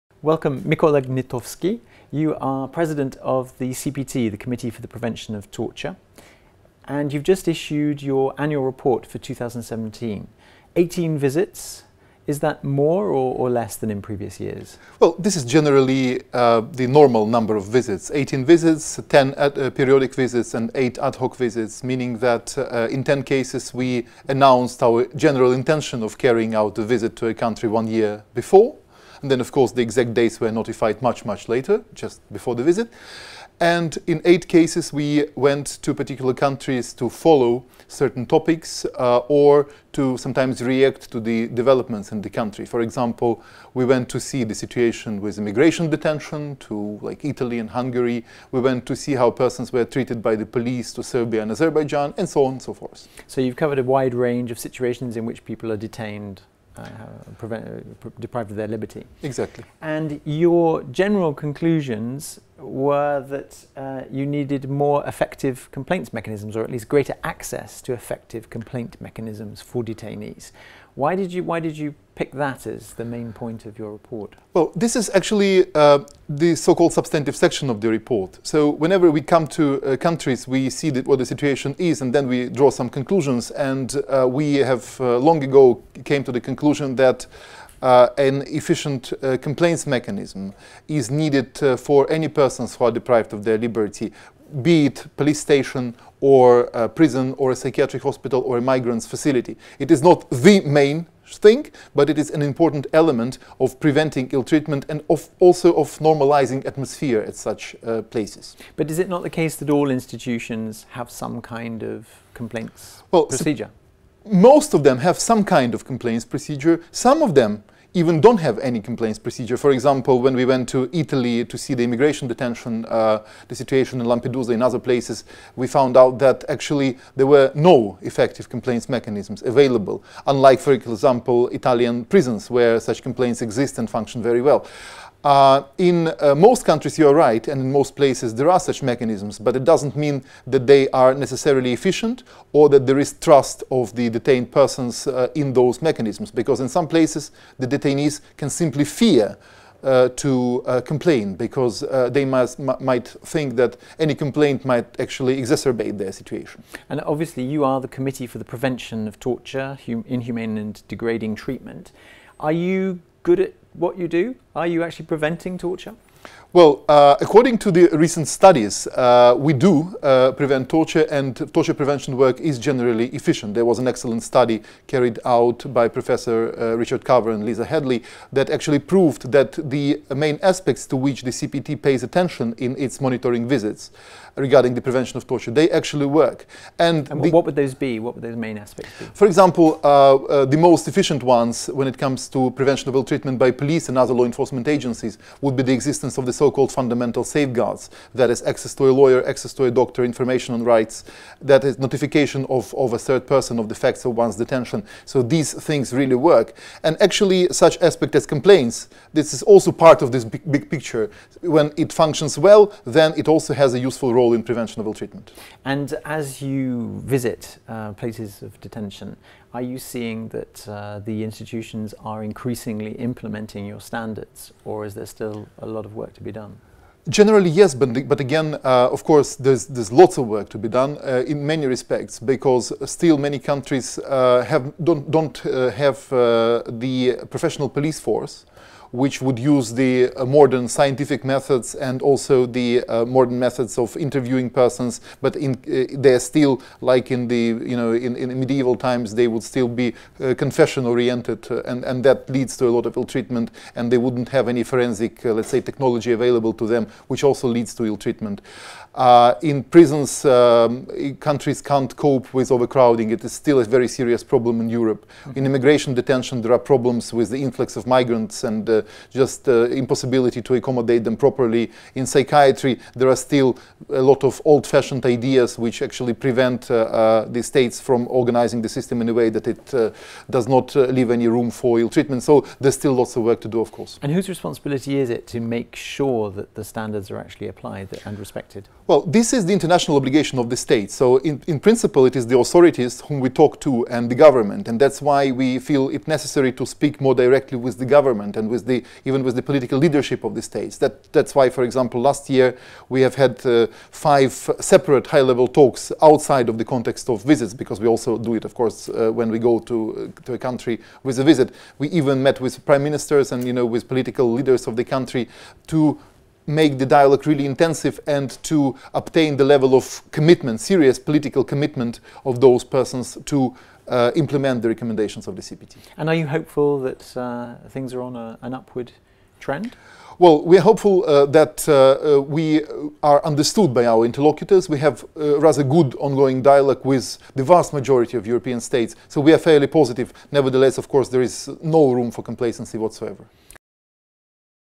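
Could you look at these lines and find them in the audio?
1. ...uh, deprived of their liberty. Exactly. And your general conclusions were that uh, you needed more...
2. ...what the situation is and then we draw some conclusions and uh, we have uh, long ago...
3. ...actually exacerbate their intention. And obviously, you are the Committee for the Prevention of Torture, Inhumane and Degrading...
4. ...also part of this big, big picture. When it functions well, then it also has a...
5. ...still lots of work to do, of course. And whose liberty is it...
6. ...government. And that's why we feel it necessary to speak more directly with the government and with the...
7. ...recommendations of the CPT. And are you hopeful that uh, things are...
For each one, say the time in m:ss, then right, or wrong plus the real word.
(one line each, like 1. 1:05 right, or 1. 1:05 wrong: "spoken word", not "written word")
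1. 0:57 right
2. 1:21 right
3. 2:34 wrong: "situation", not "intention"
4. 3:29 right
5. 4:42 wrong: "responsibility", not "liberty"
6. 4:54 right
7. 5:24 right.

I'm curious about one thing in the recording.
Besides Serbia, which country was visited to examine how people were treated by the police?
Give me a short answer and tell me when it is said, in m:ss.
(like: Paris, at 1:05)
Azerbaijan, at 0:51.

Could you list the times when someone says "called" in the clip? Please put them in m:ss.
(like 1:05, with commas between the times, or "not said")
1:16, 3:16.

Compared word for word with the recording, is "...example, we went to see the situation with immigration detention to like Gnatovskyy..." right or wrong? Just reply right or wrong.
wrong.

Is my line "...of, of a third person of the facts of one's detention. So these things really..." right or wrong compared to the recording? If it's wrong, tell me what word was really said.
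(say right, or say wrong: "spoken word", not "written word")
right.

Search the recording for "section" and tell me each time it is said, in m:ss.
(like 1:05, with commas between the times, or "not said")
1:17.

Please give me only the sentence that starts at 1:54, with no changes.
most of them have some kind of complaints procedure.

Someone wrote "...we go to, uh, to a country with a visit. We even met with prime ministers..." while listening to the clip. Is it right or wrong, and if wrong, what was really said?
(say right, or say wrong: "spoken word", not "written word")
right.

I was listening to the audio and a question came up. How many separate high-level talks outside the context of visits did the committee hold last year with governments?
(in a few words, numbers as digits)
5.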